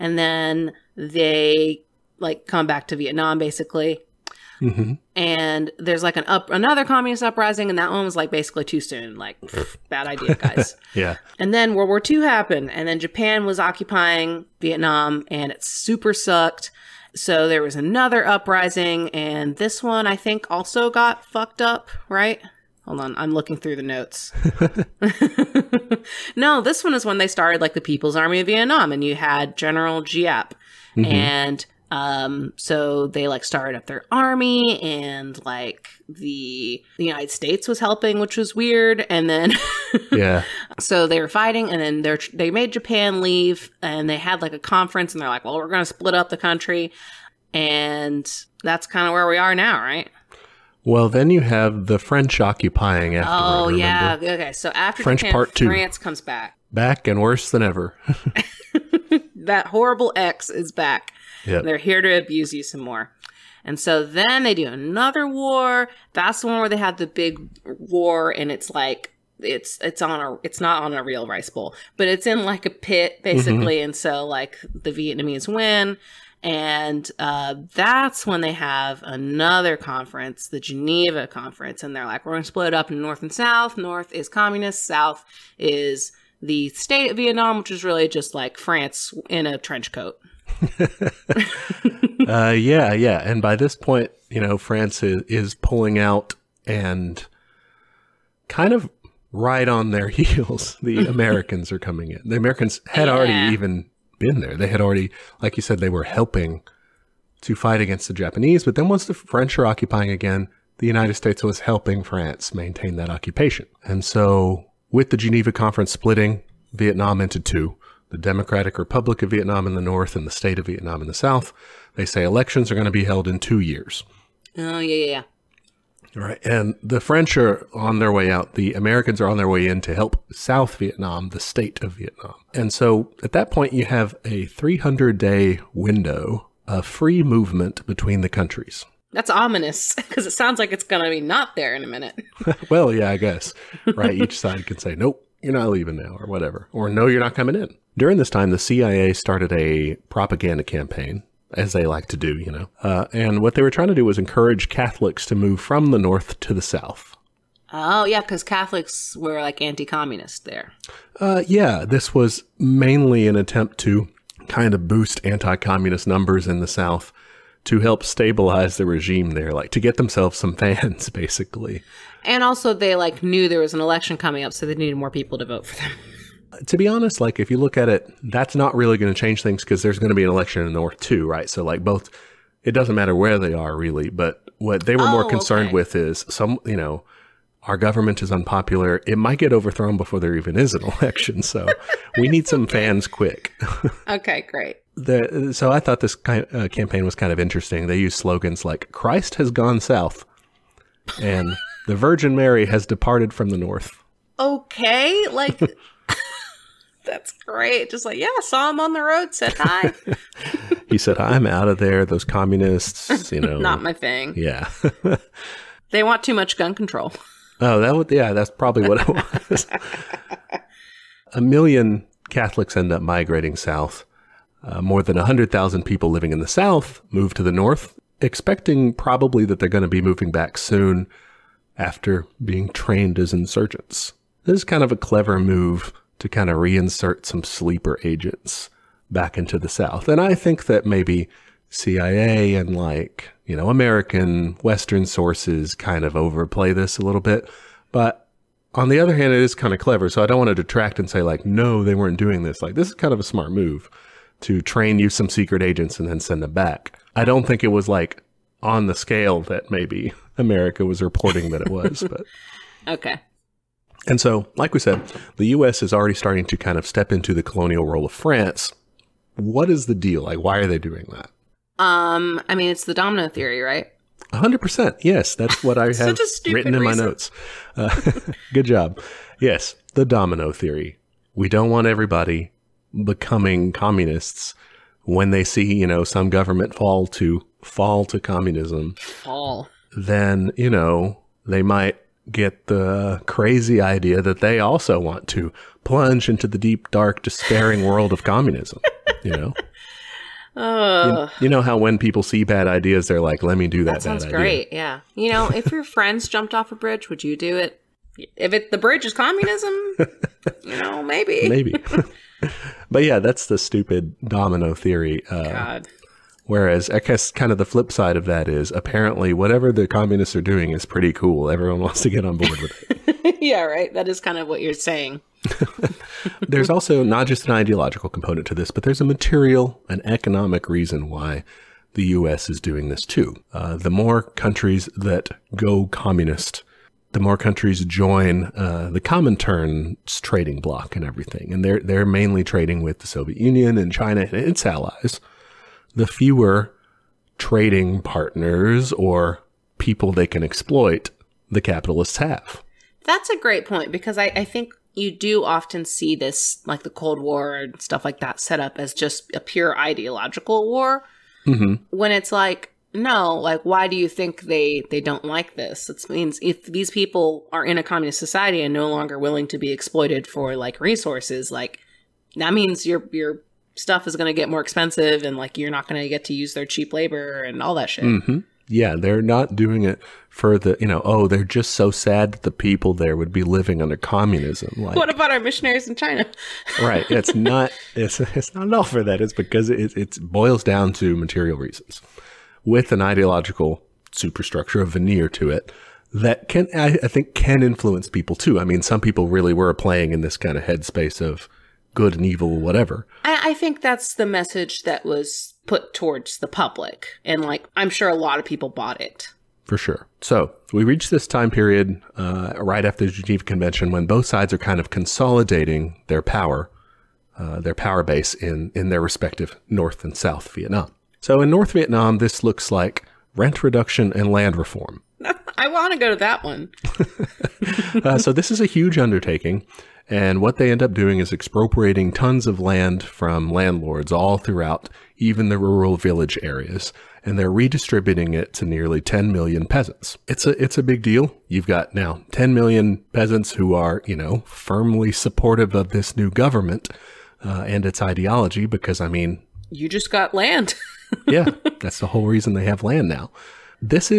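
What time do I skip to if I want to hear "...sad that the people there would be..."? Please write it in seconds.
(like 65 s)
381 s.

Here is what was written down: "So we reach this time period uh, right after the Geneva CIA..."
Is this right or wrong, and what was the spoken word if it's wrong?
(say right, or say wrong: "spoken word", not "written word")
wrong: "Convention", not "CIA".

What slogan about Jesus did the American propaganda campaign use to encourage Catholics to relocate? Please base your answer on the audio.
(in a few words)
Christ has gone south.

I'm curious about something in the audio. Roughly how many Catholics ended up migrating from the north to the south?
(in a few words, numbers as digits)
a million.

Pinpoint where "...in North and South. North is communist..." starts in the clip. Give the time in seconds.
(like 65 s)
82 s.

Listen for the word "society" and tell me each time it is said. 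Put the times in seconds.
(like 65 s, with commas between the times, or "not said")
368 s.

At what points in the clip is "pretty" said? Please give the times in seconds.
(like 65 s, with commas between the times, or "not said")
320 s.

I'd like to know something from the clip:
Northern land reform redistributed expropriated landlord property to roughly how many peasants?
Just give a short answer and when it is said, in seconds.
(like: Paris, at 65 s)
nearly 10 million, at 438 s.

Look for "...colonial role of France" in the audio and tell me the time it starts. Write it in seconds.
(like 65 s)
267 s.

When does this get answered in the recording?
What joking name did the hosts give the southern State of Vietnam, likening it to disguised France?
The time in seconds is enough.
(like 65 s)
88 s.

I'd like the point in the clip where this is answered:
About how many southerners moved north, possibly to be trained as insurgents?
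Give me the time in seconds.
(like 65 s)
224 s.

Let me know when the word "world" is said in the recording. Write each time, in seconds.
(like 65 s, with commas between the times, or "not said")
11 s, 297 s.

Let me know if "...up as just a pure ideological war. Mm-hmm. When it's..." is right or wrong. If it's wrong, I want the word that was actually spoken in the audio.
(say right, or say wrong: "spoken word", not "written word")
right.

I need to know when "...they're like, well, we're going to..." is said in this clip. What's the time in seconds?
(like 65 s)
45 s.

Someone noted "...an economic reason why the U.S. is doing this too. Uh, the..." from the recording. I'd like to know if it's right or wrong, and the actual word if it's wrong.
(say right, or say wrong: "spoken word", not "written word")
right.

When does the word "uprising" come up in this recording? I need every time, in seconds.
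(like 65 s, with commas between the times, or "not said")
7 s, 18 s.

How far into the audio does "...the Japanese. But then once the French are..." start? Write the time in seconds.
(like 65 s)
108 s.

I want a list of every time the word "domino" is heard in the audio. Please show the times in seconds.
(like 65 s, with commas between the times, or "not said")
272 s, 280 s, 314 s.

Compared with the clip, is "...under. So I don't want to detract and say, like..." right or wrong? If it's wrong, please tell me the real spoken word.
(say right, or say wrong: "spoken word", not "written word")
wrong: "clever", not "under".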